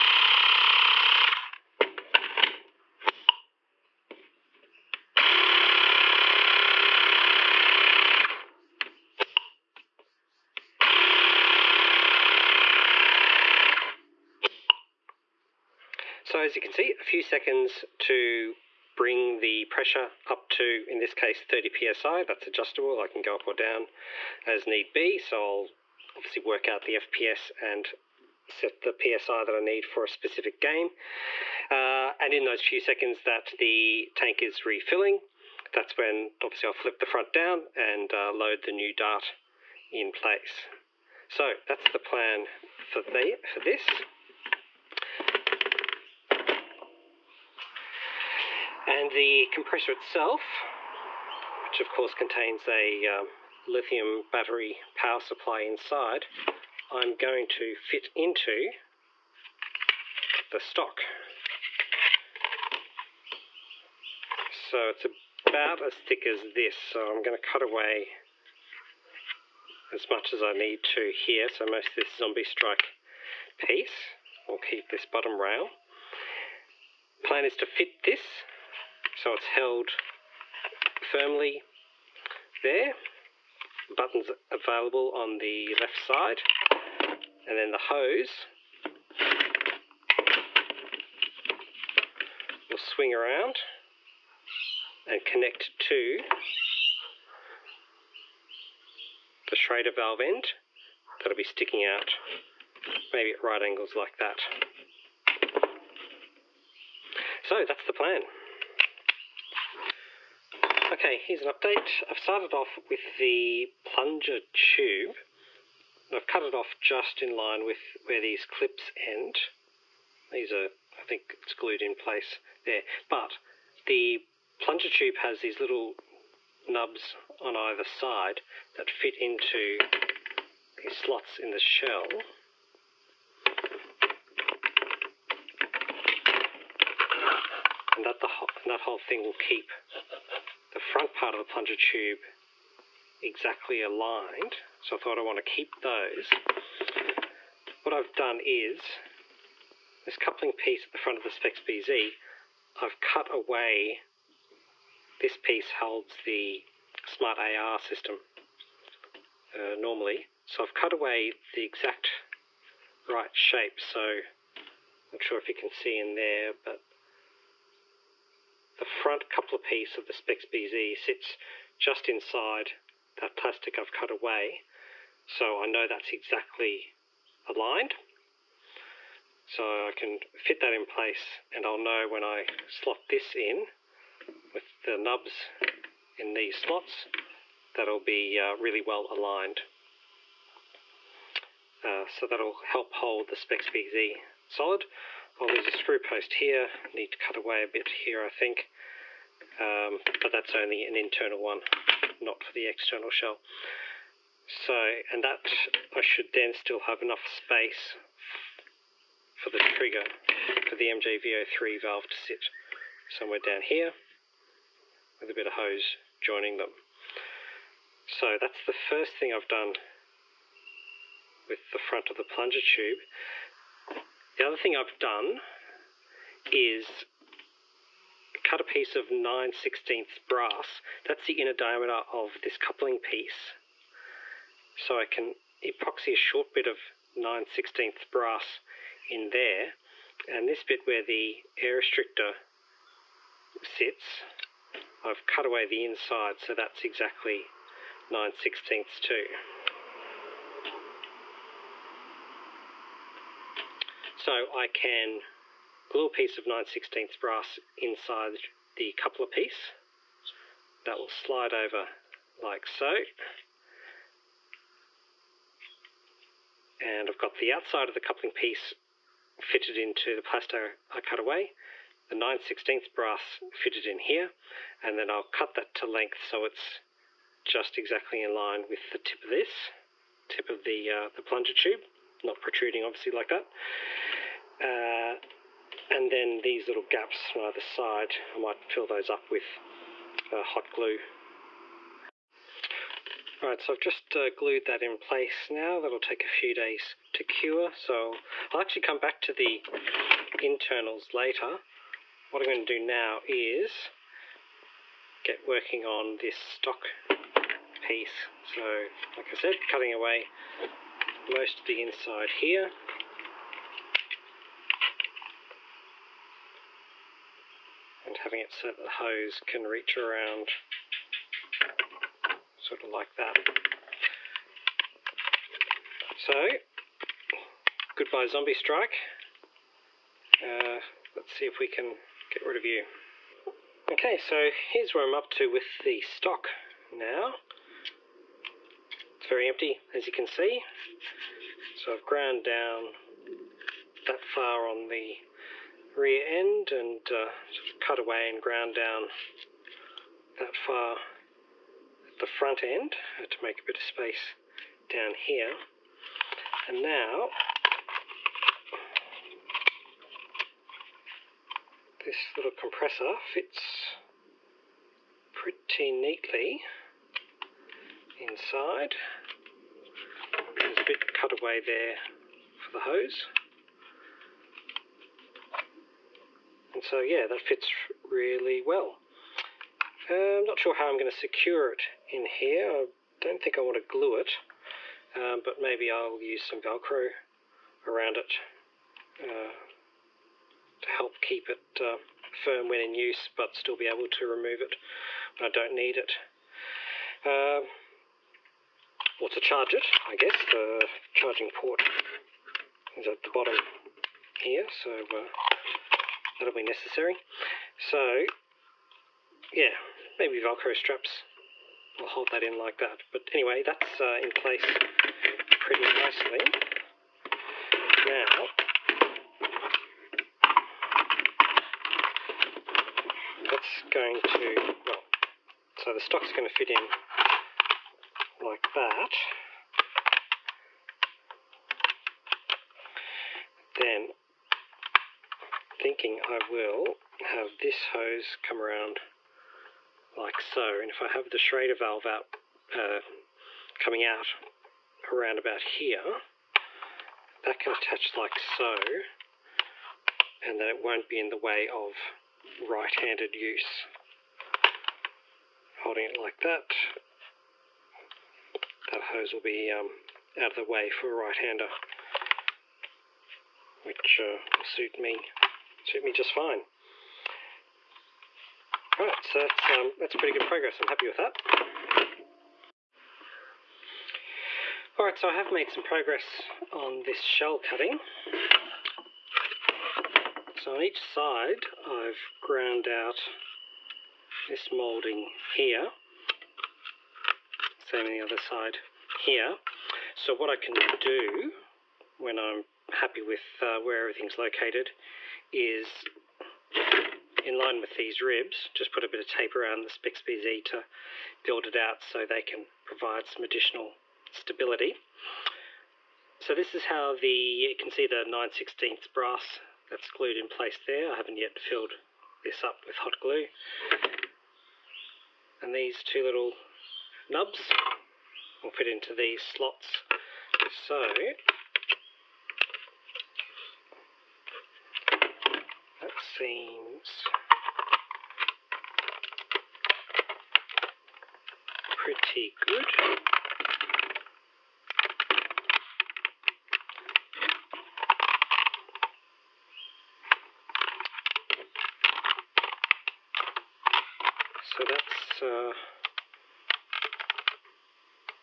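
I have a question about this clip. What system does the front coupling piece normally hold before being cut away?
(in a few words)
smart AR system.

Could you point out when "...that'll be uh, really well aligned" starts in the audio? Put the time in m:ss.
3:07.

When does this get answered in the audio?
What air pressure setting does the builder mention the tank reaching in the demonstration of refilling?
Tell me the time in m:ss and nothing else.
0:21.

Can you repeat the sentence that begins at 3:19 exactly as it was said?
Um, but that's only an internal one, not for the external shell.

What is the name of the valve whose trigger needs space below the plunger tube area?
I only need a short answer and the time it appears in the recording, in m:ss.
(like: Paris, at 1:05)
MJVO3, at 3:30.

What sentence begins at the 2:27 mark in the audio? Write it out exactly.
What I've done is this coupling piece at the front of the Spexbz, I've cut away.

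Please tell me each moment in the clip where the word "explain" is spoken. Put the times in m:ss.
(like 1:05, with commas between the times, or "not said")
not said.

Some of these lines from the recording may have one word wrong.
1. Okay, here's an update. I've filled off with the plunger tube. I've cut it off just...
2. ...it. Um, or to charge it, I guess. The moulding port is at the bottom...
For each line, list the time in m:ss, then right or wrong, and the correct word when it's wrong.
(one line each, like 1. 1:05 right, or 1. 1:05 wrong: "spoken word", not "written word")
1. 1:50 wrong: "started", not "filled"
2. 6:35 wrong: "charging", not "moulding".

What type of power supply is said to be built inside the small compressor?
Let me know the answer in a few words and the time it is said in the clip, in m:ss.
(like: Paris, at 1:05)
lithium battery, at 0:53.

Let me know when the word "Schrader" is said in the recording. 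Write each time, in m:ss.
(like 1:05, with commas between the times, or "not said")
1:39, 7:21.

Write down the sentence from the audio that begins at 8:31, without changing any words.
I haven't yet filled this up with hot glue.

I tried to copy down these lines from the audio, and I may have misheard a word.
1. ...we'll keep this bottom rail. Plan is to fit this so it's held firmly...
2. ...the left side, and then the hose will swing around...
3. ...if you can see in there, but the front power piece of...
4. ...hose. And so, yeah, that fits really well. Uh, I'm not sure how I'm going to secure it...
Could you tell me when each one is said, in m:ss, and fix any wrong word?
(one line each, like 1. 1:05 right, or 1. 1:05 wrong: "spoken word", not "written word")
1. 1:14 right
2. 1:25 right
3. 2:45 wrong: "coupler", not "power"
4. 6:12 right.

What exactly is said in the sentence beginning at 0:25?
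So I'll obviously work out the FPS and set the psi that I need for a specific game.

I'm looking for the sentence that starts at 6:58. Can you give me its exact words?
Now, that's going to, well, so the stock's going to fit in like that.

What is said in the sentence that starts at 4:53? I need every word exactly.
Alright, so I've just uh, glued that in place now.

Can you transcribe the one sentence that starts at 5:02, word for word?
What I'm going to do now is get working on this stock piece.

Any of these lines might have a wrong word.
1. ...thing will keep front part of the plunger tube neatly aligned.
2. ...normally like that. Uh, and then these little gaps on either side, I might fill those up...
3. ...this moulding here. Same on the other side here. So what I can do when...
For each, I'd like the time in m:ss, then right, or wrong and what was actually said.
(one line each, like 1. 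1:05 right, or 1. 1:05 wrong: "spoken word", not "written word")
1. 2:18 wrong: "exactly", not "neatly"
2. 4:42 wrong: "obviously", not "normally"
3. 8:04 right.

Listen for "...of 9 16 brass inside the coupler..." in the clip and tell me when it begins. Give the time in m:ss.
4:16.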